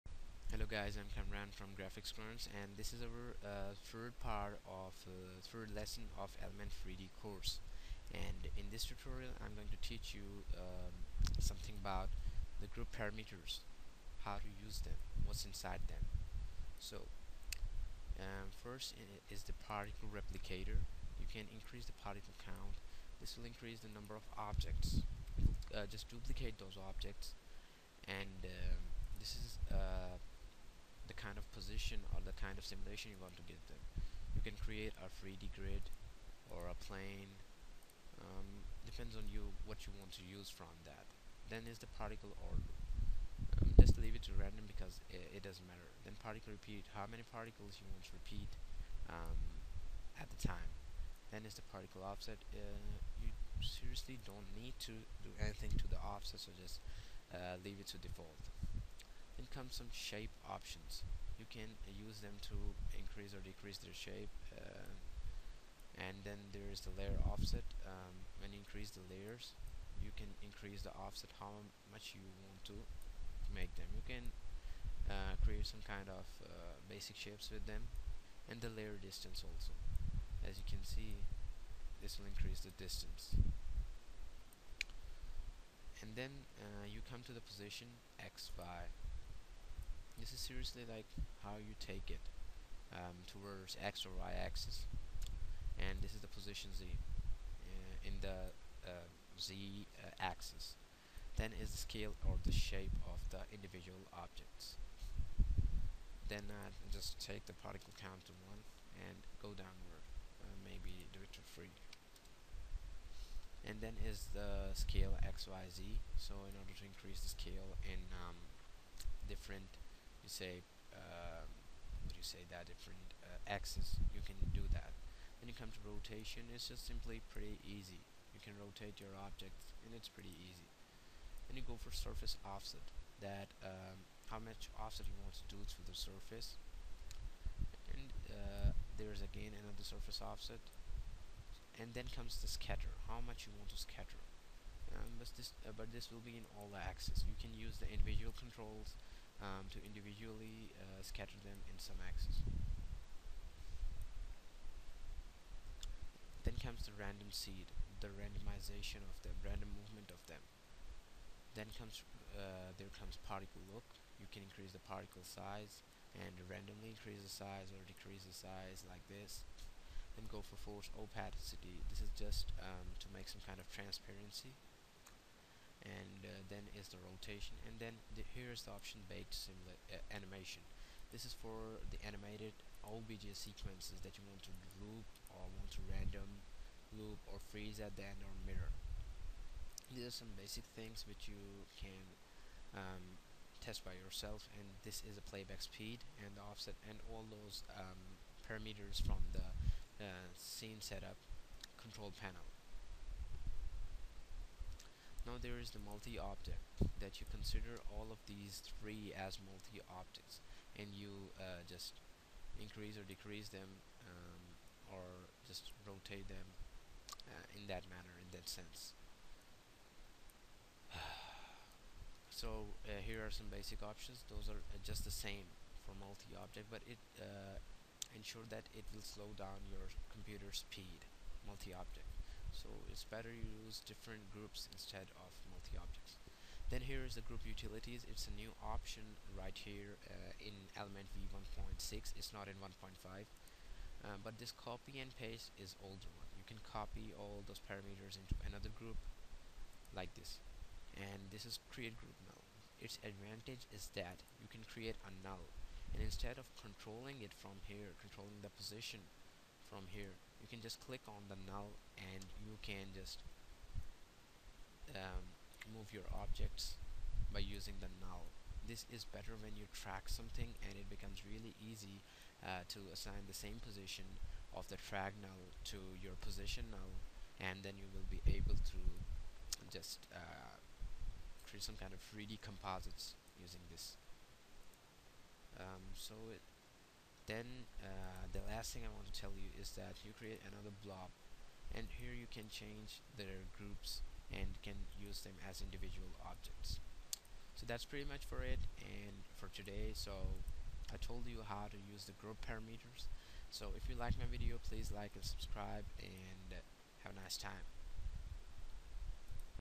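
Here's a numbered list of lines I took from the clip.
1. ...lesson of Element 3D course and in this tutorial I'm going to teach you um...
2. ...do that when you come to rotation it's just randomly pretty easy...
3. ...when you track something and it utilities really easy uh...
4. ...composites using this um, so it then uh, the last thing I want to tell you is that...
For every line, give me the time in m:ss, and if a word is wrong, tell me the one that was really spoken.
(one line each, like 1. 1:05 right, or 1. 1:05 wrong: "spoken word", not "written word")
1. 0:05 right
2. 2:04 wrong: "simply", not "randomly"
3. 4:29 wrong: "becomes", not "utilities"
4. 4:42 right.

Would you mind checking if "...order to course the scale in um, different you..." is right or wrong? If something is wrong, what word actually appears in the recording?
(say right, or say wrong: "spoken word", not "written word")
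wrong: "increase", not "course".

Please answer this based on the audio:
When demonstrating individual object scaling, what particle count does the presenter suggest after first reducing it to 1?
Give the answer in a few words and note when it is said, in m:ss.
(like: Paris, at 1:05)
3, at 1:51.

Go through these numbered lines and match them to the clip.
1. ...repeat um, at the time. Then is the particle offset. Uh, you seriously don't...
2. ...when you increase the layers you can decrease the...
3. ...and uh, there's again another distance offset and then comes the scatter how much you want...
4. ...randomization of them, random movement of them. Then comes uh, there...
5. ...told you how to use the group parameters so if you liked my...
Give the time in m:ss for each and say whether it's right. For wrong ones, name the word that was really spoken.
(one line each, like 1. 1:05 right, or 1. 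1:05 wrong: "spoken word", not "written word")
1. 0:48 right
2. 1:08 wrong: "increase", not "decrease"
3. 2:17 wrong: "surface", not "distance"
4. 2:38 right
5. 5:00 right.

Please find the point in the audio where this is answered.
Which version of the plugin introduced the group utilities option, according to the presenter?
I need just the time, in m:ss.
4:01.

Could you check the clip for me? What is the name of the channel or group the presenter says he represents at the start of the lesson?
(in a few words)
GraphixGruntz.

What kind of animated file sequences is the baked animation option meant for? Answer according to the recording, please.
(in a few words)
OBJ sequences.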